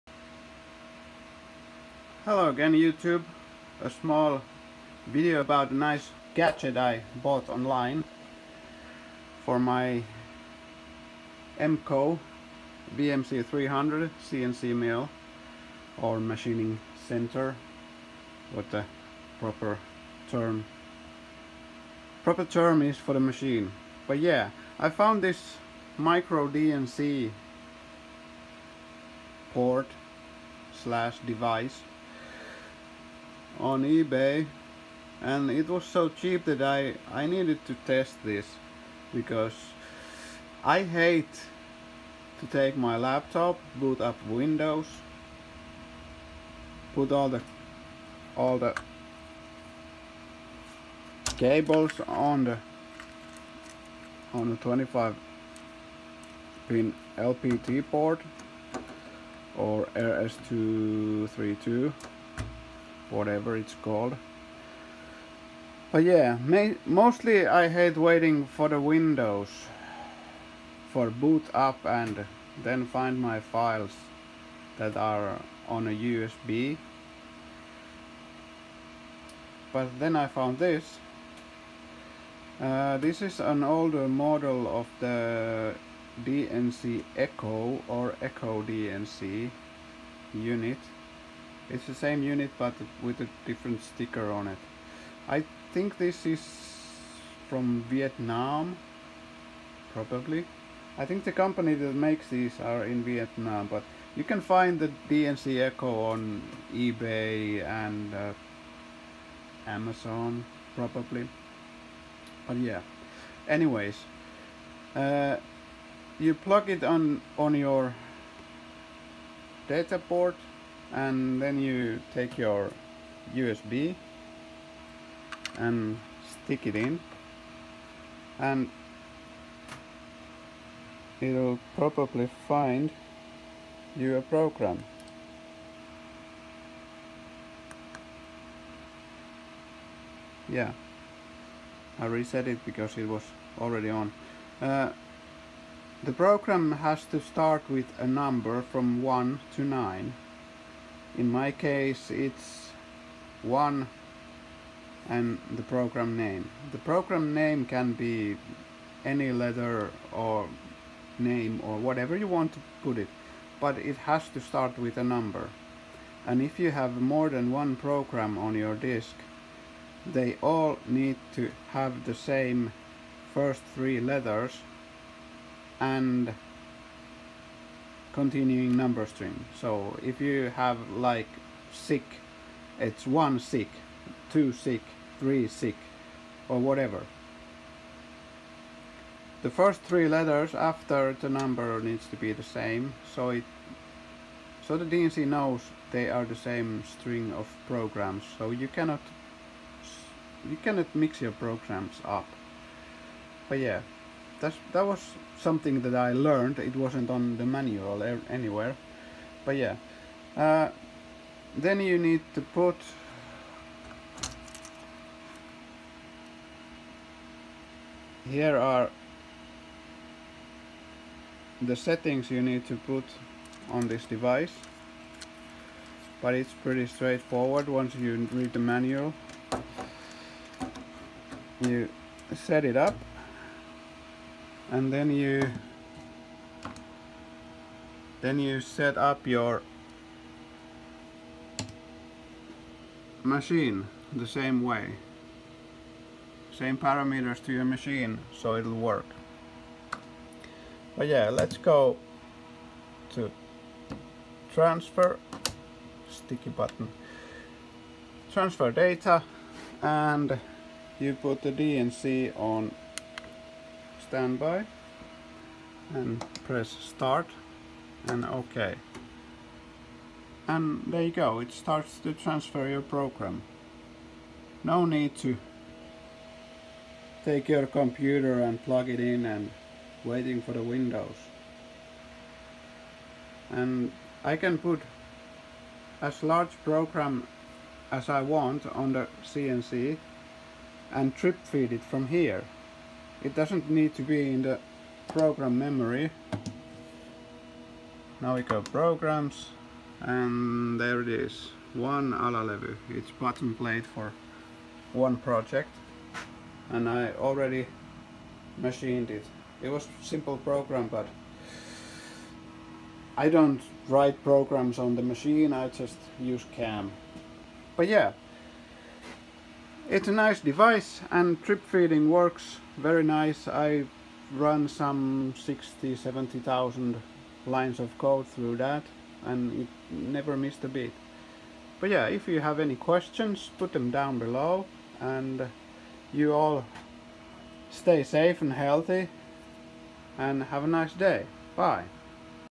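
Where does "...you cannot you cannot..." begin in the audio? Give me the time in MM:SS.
03:18.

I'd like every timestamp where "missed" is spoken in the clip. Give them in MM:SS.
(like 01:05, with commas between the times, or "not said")
05:30.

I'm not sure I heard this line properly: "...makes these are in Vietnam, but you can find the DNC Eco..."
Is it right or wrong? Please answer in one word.
right.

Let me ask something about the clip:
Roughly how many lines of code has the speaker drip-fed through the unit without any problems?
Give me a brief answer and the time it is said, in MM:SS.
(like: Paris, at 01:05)
60,000-70,000, at 05:25.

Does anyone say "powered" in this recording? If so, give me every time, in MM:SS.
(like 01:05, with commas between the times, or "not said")
not said.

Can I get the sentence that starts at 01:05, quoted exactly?
But yeah, mostly I hate waiting for the Windows for boot up and then find my files that are on a USB.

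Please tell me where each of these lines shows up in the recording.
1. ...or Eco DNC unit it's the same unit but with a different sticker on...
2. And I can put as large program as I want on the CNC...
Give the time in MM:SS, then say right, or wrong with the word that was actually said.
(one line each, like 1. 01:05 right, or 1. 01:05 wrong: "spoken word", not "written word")
1. 01:27 right
2. 04:43 right.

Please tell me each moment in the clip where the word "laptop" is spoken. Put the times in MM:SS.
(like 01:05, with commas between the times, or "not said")
00:42.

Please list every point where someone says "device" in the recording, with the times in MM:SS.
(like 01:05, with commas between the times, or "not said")
00:31, 03:44, 05:20.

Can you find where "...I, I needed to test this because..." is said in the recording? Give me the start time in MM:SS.
00:36.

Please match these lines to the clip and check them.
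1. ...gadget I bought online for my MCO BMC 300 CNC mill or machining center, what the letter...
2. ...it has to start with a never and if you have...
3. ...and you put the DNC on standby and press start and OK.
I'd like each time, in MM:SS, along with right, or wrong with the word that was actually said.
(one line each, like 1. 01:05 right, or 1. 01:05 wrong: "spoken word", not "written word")
1. 00:06 wrong: "proper", not "letter"
2. 02:43 wrong: "number", not "never"
3. 04:19 right.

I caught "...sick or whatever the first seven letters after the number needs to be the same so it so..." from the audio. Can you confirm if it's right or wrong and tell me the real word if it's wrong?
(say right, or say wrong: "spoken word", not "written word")
wrong: "three", not "seven".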